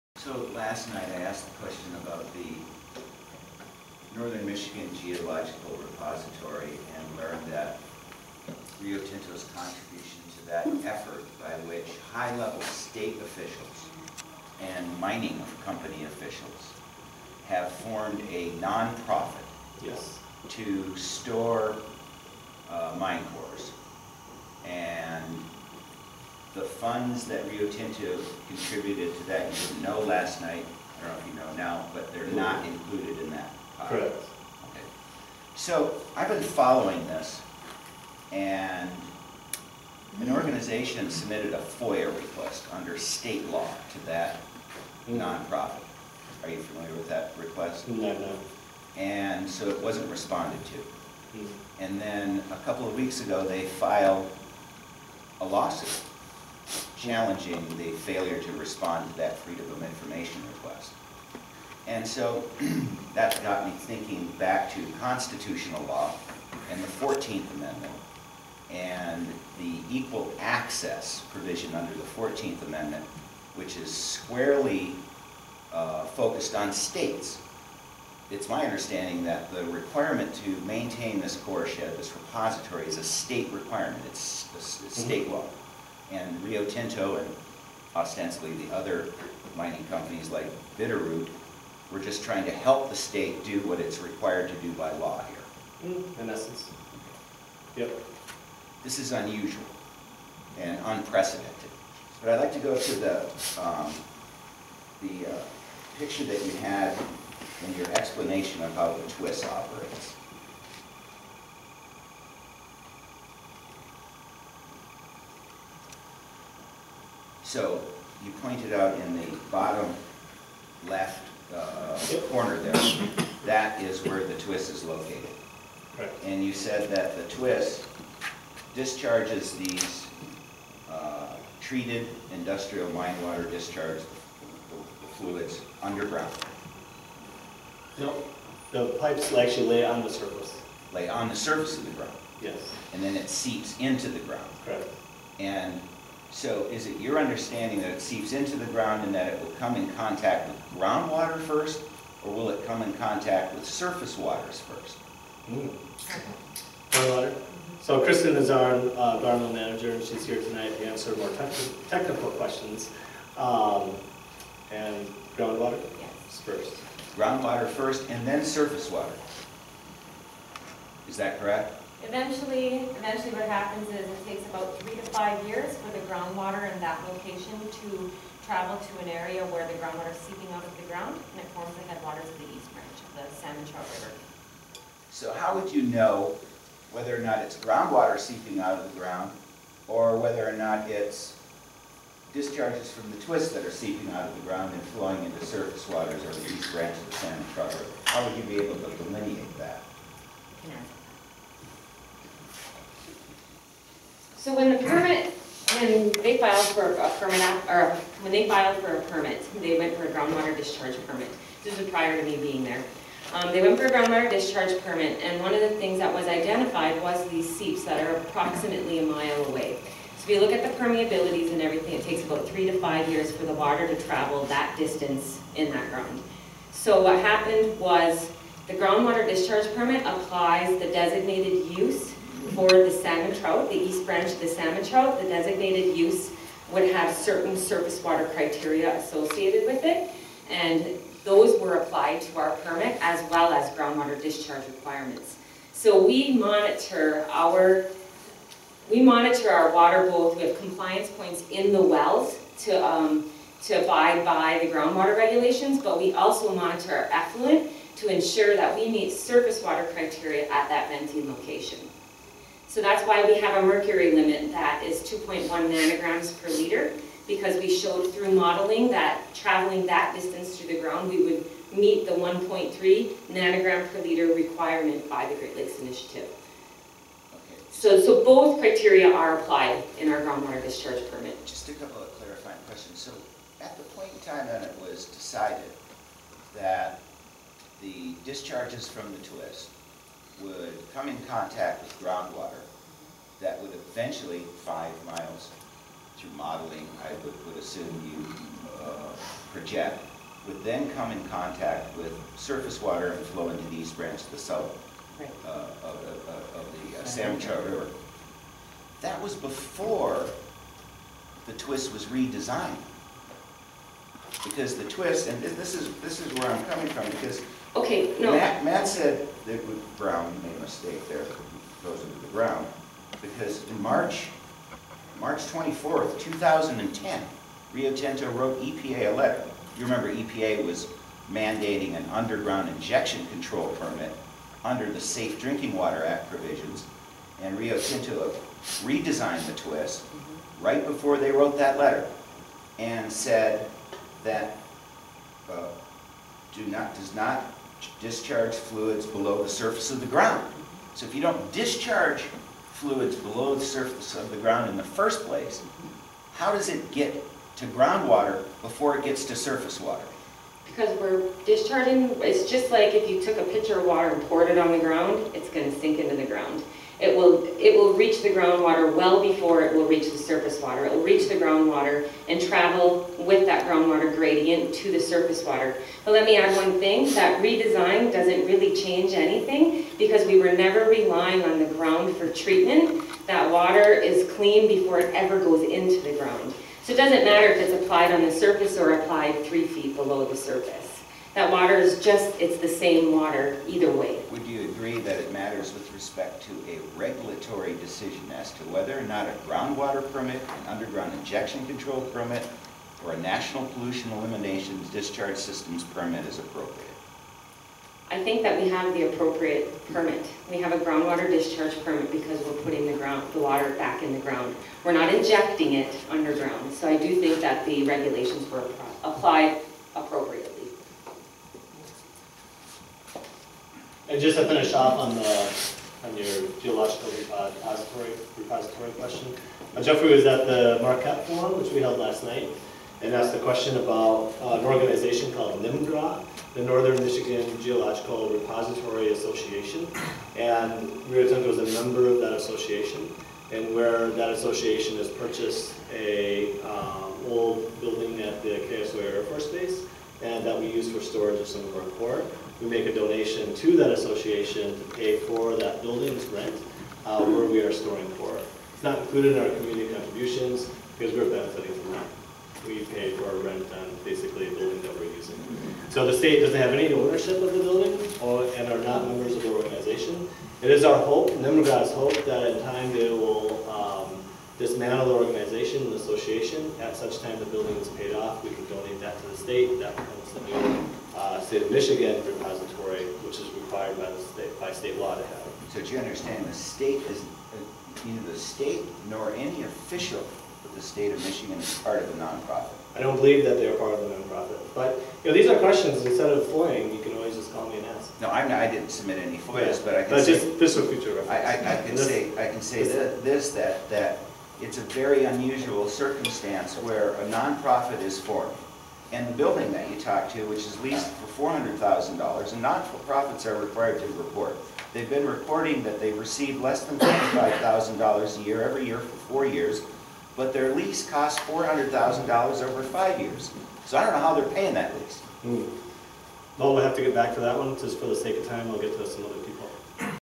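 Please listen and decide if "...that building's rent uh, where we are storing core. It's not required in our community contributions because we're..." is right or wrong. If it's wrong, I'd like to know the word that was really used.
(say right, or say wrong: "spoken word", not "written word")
wrong: "included", not "required".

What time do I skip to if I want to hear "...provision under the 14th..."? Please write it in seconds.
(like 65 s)
71 s.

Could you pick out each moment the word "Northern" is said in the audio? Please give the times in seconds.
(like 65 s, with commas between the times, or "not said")
4 s, 436 s.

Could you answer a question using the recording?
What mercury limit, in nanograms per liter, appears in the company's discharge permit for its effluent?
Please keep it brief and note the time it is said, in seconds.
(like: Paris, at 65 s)
2.1 nanograms per liter, at 265 s.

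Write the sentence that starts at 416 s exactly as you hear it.
So I do think that the regulations were applied appropriately.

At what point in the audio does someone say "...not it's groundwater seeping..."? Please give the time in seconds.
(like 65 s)
187 s.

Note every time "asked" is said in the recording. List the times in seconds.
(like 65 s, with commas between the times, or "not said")
1 s, 433 s.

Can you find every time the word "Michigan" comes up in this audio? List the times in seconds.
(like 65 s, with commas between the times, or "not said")
4 s, 437 s, 481 s, 491 s.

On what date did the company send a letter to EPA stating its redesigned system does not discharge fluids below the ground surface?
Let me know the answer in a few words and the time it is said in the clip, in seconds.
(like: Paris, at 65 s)
March 24, 2010, at 325 s.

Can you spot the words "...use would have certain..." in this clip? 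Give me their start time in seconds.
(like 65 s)
235 s.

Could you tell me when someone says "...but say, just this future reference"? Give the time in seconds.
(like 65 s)
500 s.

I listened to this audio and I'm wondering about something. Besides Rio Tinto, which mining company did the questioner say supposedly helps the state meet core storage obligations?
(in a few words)
Bitterroot.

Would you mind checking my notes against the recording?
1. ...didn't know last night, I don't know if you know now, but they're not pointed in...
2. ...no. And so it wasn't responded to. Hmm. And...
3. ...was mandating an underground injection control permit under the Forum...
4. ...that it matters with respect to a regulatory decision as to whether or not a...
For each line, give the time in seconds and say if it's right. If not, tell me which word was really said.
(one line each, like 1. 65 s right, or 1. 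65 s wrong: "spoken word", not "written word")
1. 29 s wrong: "included", not "pointed"
2. 48 s right
3. 330 s wrong: "Safe", not "Forum"
4. 394 s right.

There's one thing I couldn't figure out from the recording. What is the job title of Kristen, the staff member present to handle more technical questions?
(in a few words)
environmental manager.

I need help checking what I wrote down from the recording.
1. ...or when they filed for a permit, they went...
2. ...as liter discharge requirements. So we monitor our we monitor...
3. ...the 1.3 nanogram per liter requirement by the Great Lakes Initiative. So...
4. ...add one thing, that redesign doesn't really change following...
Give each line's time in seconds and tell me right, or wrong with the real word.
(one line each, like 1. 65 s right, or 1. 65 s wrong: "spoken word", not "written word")
1. 207 s right
2. 243 s wrong: "groundwater", not "liter"
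3. 272 s right
4. 376 s wrong: "anything", not "following".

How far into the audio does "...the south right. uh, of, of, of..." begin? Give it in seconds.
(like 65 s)
304 s.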